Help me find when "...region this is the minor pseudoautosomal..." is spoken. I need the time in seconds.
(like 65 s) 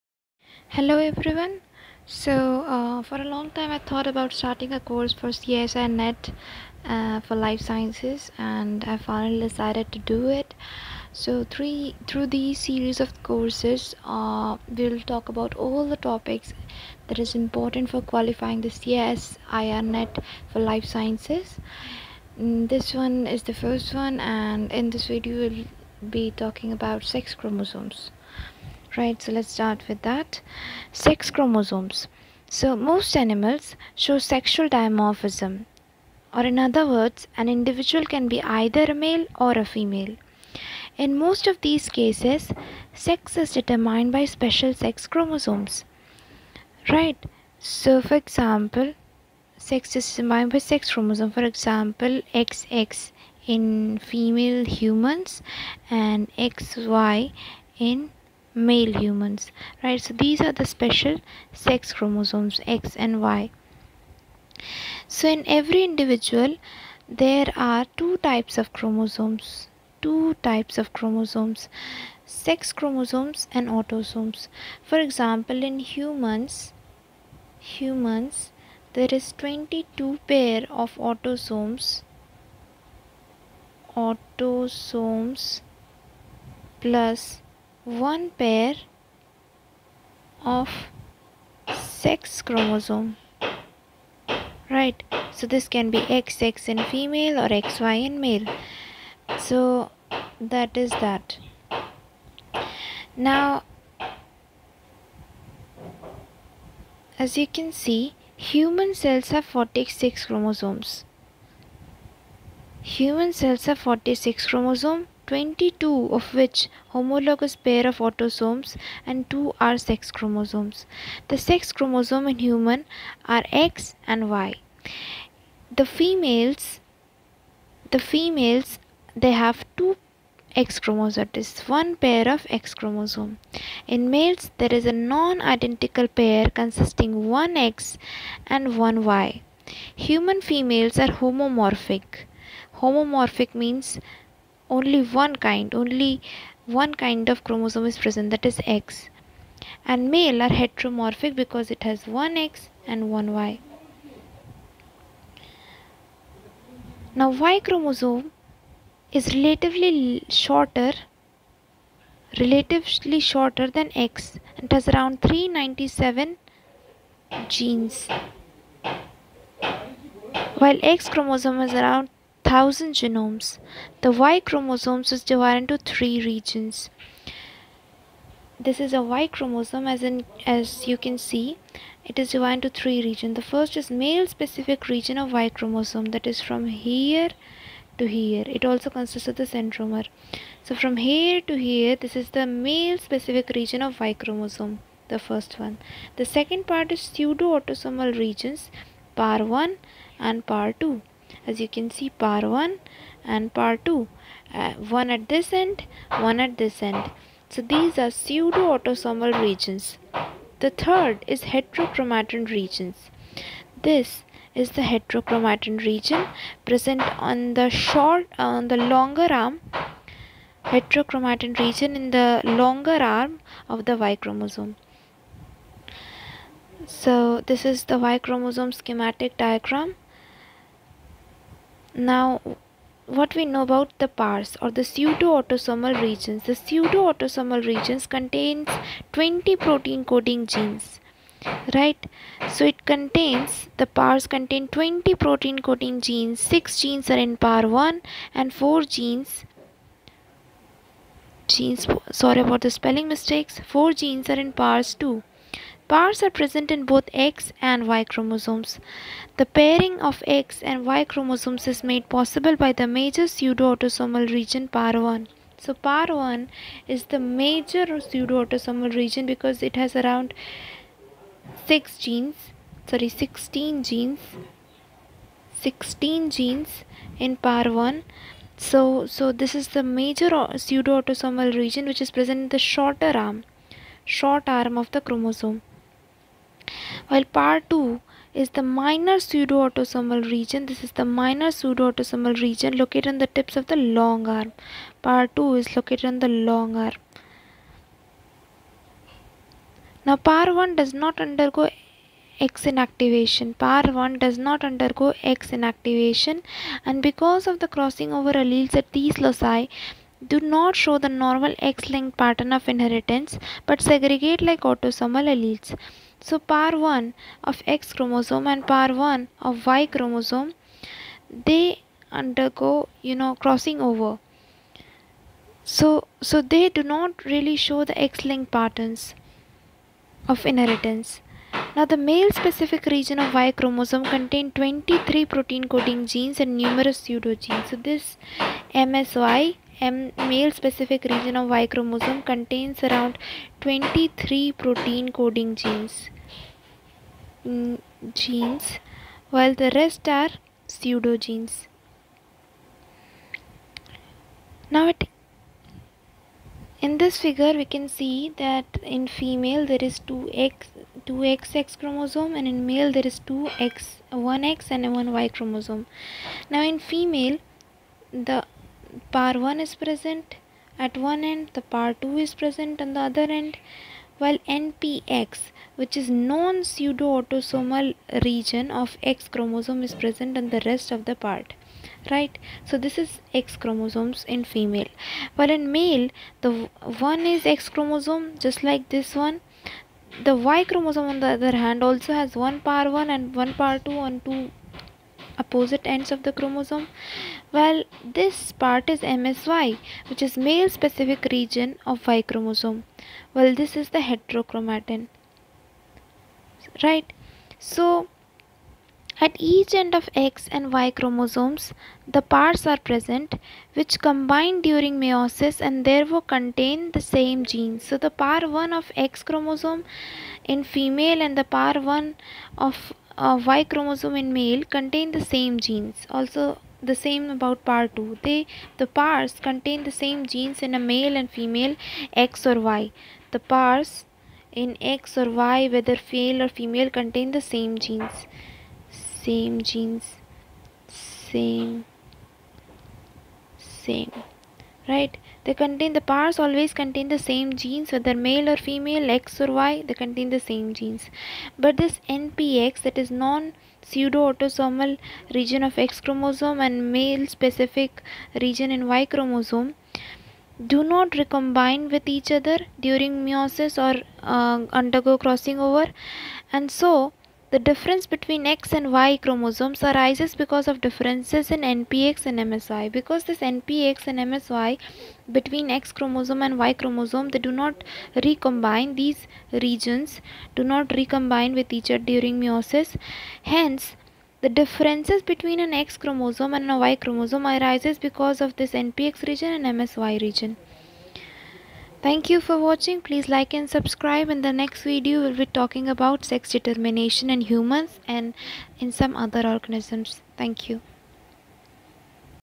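290 s.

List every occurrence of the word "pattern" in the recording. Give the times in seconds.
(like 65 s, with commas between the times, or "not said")
312 s, 328 s.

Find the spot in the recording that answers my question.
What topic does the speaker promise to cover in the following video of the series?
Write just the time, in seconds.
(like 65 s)
496 s.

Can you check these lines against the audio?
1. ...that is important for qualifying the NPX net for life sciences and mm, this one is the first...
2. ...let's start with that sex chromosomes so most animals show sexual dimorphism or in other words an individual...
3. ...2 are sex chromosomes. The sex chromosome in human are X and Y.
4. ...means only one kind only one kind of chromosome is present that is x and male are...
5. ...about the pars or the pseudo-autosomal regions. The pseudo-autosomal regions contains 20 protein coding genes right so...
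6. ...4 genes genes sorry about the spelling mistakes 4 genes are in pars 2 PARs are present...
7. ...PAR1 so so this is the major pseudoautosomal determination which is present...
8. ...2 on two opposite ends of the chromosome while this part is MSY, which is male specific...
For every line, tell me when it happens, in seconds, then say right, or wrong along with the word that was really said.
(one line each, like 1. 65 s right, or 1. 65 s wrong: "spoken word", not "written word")
1. 17 s wrong: "CSIR", not "NPX"
2. 29 s right
3. 119 s right
4. 143 s right
5. 233 s right
6. 248 s right
7. 277 s wrong: "region", not "determination"
8. 393 s right.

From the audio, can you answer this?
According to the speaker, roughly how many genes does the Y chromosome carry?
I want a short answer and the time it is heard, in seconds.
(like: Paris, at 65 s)
397, at 165 s.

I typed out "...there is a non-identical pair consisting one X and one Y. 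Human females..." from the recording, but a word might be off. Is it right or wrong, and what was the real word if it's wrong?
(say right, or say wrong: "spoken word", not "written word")
right.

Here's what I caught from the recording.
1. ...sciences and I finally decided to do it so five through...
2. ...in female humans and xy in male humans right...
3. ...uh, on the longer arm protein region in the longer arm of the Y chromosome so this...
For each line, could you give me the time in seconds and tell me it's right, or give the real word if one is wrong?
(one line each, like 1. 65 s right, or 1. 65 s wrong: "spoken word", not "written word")
1. 7 s wrong: "three", not "five"
2. 53 s right
3. 218 s wrong: "heterochromatin", not "protein".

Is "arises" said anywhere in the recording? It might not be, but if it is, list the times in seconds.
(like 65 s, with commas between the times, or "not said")
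469 s, 487 s.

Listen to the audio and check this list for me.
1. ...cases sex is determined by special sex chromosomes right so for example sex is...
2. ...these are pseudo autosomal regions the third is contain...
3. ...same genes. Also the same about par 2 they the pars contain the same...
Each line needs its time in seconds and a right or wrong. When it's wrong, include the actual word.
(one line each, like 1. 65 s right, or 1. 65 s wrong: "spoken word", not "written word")
1. 41 s right
2. 207 s wrong: "heterochromatin", not "contain"
3. 425 s right.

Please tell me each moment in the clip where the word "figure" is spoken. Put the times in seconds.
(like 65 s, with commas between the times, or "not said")
357 s.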